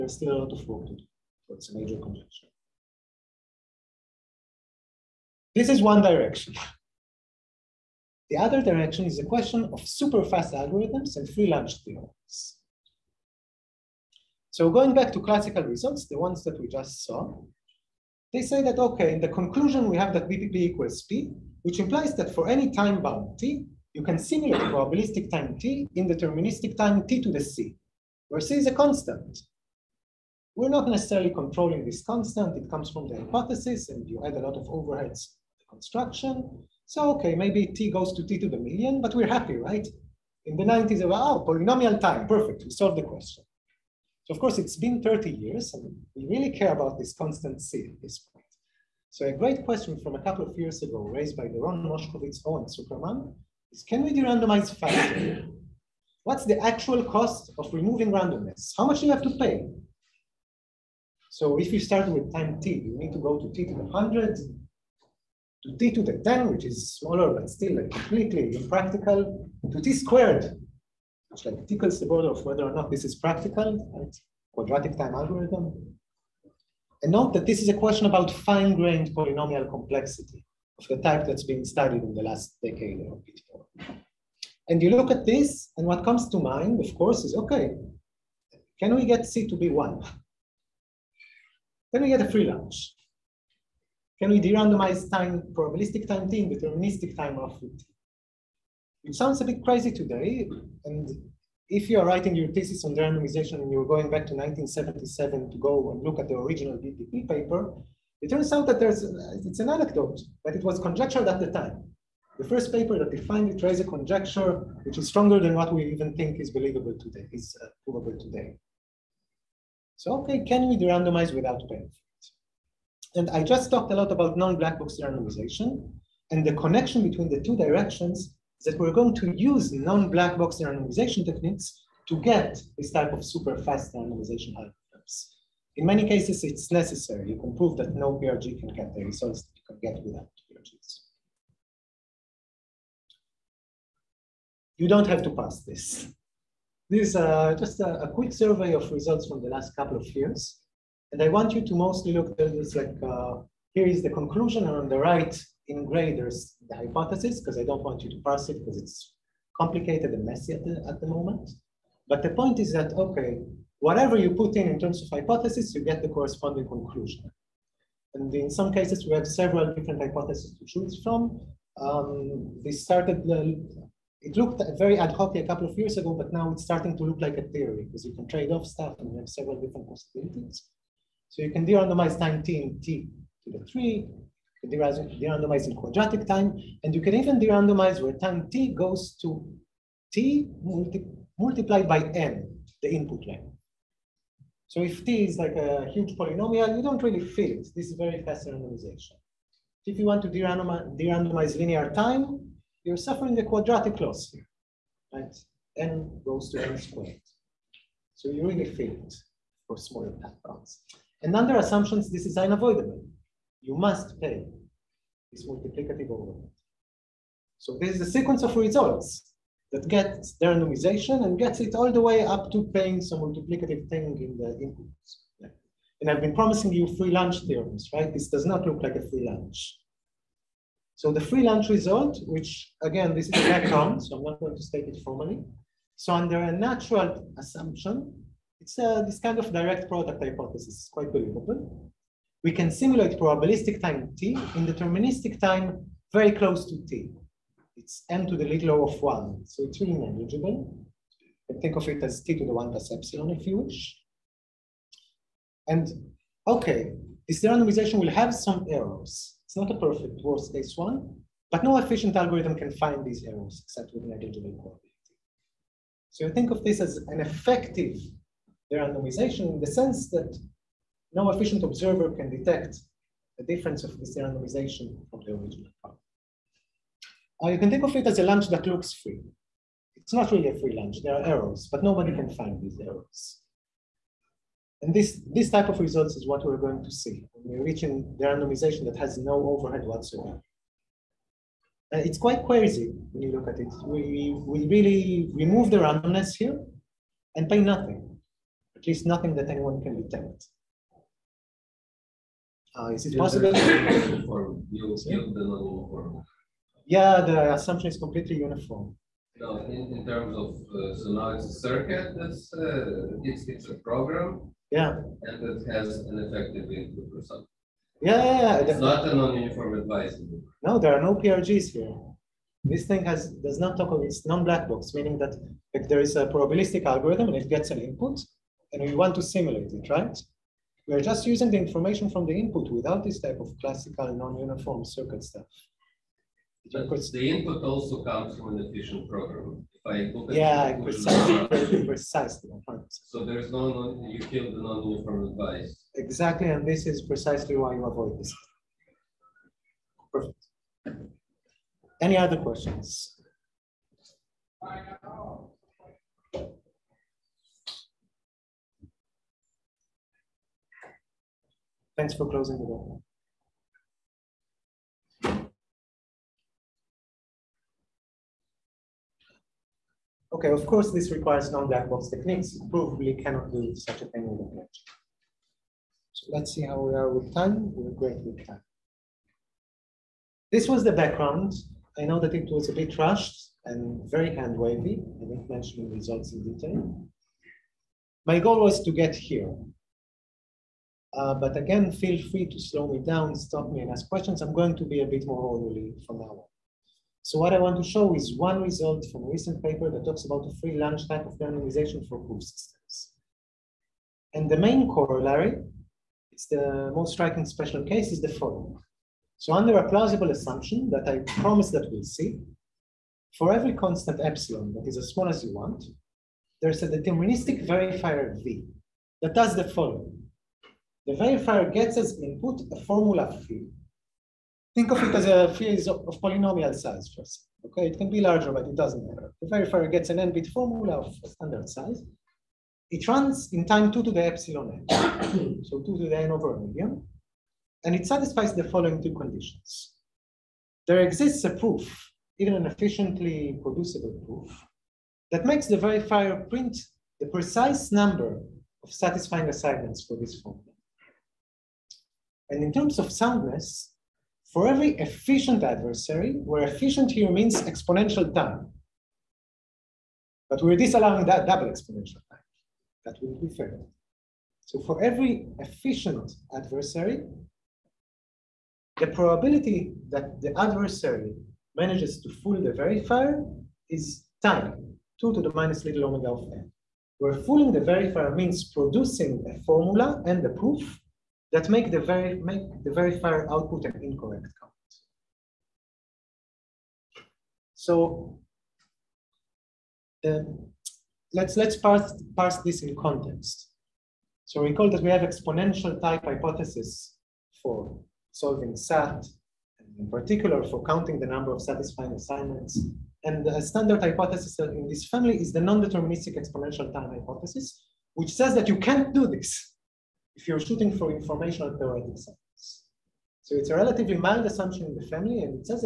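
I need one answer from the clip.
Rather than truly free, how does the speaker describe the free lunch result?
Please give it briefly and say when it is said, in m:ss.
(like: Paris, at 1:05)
a lunch that looks free, at 4:38.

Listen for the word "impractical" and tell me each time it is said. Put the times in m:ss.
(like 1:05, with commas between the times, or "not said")
1:08.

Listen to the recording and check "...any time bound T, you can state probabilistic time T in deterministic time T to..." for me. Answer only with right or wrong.
wrong.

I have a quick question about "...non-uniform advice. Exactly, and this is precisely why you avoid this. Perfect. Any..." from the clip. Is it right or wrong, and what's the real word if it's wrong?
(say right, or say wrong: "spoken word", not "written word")
right.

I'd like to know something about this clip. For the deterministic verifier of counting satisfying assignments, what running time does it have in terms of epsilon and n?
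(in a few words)
2 to the epsilon n.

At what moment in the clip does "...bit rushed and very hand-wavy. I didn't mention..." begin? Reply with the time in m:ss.
6:22.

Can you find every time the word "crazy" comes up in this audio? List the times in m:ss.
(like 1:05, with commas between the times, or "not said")
1:39, 4:52.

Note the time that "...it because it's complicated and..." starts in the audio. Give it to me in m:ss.
2:38.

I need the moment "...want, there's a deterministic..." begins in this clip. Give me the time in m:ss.
6:55.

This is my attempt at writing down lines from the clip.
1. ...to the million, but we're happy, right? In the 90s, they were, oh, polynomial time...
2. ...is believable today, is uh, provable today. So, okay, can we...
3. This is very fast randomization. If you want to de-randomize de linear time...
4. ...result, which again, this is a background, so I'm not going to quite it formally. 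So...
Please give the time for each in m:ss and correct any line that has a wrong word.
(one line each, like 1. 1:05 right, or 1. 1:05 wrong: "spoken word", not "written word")
1. 0:38 right
2. 1:56 right
3. 3:17 right
4. 3:51 wrong: "state", not "quite".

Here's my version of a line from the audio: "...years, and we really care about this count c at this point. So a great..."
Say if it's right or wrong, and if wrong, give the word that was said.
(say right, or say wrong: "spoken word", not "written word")
wrong: "constant", not "count".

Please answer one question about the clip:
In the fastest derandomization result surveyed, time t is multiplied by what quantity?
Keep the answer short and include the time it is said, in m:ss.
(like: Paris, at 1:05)
the input length, at 3:12.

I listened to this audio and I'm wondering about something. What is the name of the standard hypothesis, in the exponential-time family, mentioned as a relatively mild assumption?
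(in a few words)
non-deterministic exponential time hypothesis.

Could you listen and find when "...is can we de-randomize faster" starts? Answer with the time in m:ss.
0:53.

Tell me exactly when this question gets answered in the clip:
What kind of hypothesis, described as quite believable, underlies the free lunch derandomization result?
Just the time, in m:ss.
3:59.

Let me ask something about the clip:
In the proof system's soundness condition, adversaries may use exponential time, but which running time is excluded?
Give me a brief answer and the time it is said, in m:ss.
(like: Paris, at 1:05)
double exponential time, at 7:41.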